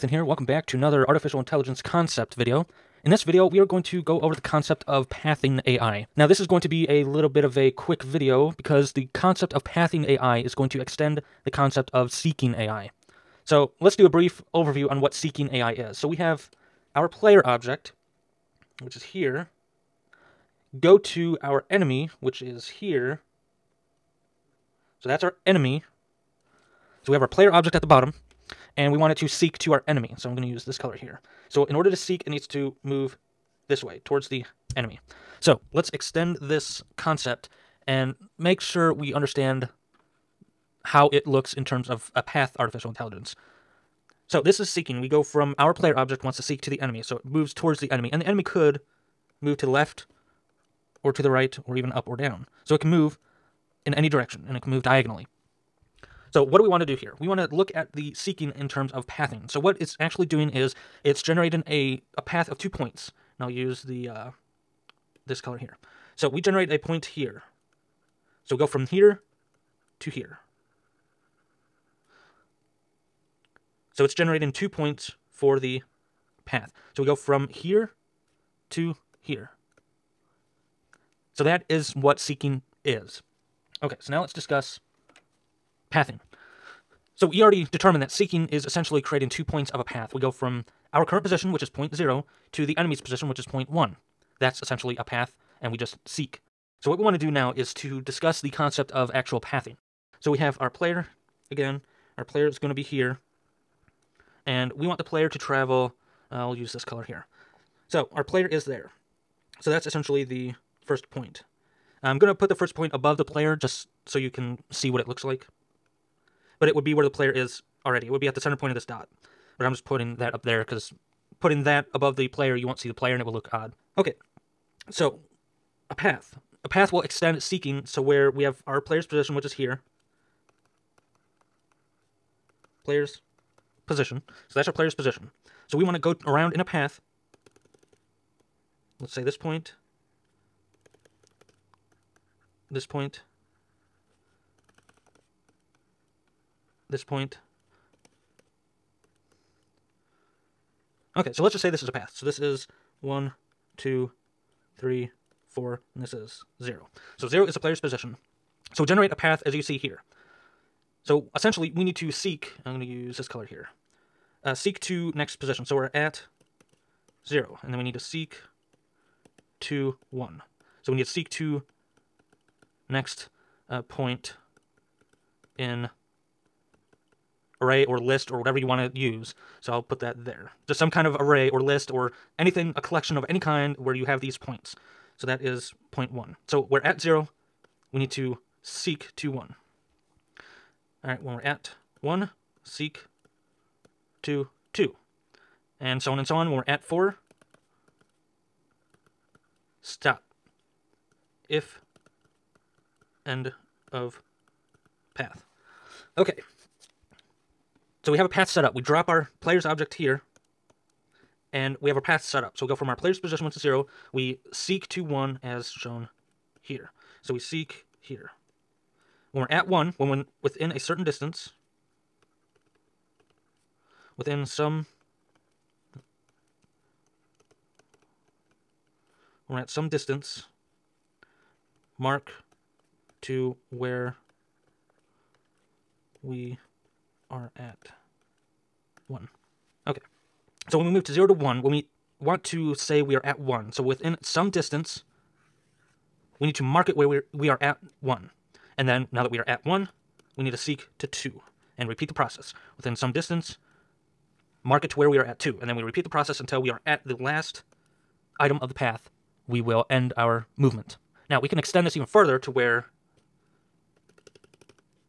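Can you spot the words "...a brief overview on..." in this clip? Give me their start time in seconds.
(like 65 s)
14 s.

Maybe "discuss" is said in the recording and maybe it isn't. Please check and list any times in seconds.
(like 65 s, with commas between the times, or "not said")
84 s, 98 s.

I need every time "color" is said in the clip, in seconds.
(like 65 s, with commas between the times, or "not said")
30 s, 65 s, 106 s, 163 s.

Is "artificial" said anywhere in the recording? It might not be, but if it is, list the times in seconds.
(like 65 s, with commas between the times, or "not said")
1 s, 42 s.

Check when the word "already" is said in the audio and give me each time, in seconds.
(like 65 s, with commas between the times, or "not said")
87 s, 117 s.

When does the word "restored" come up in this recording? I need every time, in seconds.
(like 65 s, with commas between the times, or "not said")
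not said.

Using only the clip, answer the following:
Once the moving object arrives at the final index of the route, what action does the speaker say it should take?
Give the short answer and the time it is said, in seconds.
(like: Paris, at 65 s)
stop, at 199 s.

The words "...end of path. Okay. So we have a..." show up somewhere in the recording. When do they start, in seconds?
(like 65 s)
203 s.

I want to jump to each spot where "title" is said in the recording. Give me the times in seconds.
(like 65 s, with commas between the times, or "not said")
not said.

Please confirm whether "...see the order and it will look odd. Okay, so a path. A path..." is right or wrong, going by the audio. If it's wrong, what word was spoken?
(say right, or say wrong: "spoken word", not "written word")
wrong: "player", not "order".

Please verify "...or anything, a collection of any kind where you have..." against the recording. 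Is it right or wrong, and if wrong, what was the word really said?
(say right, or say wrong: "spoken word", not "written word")
right.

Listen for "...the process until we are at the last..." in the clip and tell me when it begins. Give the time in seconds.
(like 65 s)
256 s.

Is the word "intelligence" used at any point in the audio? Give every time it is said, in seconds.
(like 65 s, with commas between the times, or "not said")
1 s, 42 s.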